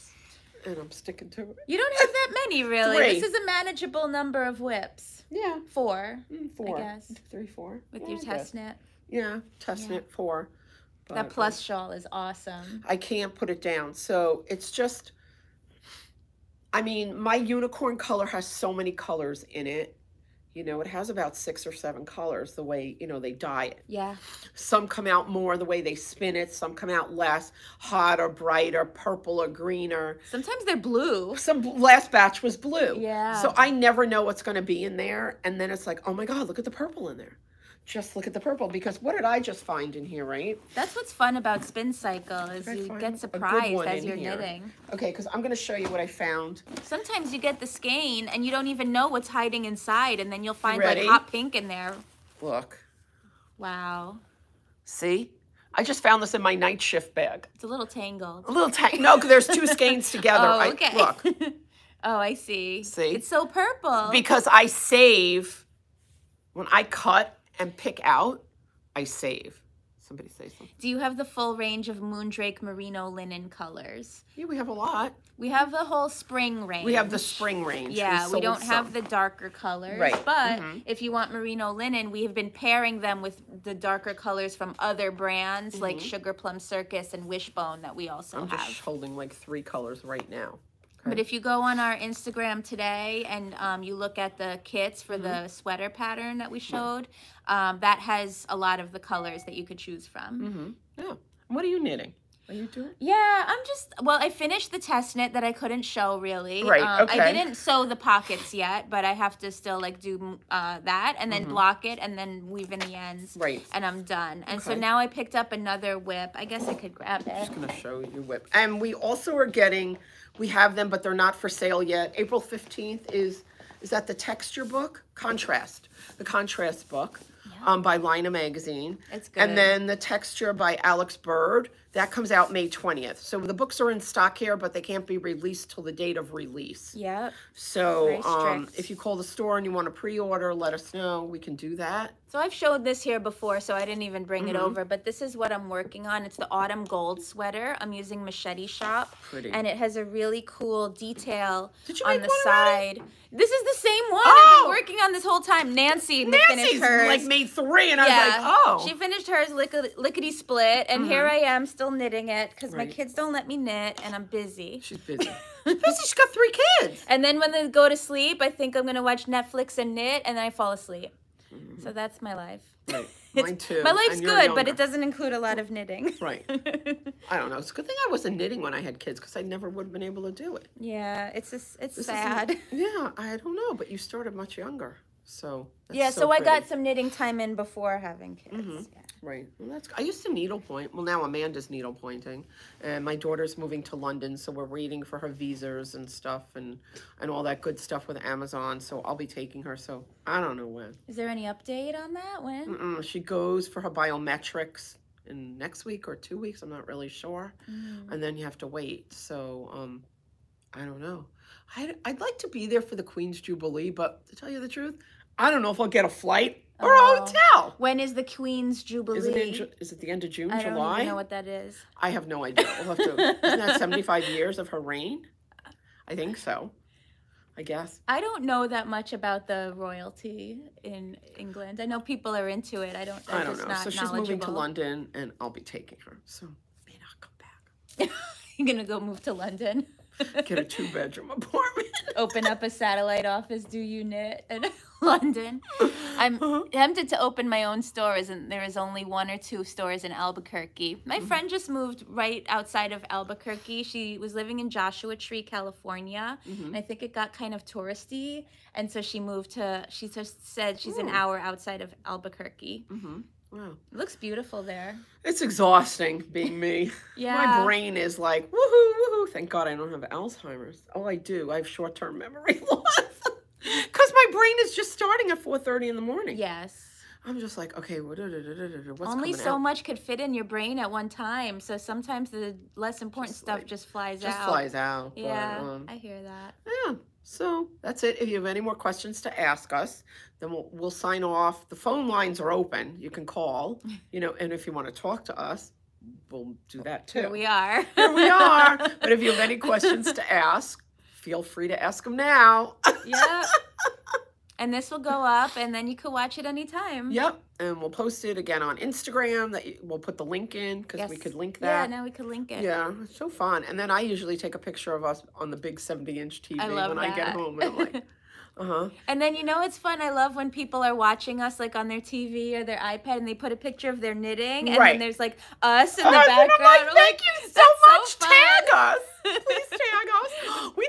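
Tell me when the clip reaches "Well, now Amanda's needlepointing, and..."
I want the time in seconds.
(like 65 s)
190 s.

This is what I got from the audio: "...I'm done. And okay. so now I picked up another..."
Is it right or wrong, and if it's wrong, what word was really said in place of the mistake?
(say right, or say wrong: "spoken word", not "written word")
right.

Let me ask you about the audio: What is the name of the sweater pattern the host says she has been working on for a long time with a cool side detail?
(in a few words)
autumn gold sweater.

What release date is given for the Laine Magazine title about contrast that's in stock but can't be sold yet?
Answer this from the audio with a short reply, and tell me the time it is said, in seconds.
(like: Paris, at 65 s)
April 15th, at 122 s.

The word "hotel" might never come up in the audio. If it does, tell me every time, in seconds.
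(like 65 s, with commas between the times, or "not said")
217 s.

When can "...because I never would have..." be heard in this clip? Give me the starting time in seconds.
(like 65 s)
179 s.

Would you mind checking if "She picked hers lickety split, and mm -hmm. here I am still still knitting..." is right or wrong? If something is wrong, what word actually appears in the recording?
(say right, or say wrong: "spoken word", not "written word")
wrong: "finished", not "picked".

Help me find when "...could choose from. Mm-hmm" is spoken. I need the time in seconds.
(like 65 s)
99 s.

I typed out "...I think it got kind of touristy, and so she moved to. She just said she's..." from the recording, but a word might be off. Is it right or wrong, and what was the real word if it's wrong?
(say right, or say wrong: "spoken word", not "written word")
right.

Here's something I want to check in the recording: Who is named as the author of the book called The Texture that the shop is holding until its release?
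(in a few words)
Alex Bird.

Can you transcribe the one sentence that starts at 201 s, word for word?
Is there any update on that?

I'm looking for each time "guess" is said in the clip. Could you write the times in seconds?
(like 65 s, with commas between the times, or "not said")
6 s, 116 s, 227 s.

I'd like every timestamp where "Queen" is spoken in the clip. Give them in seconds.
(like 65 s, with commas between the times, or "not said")
213 s, 218 s.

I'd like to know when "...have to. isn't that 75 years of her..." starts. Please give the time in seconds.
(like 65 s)
222 s.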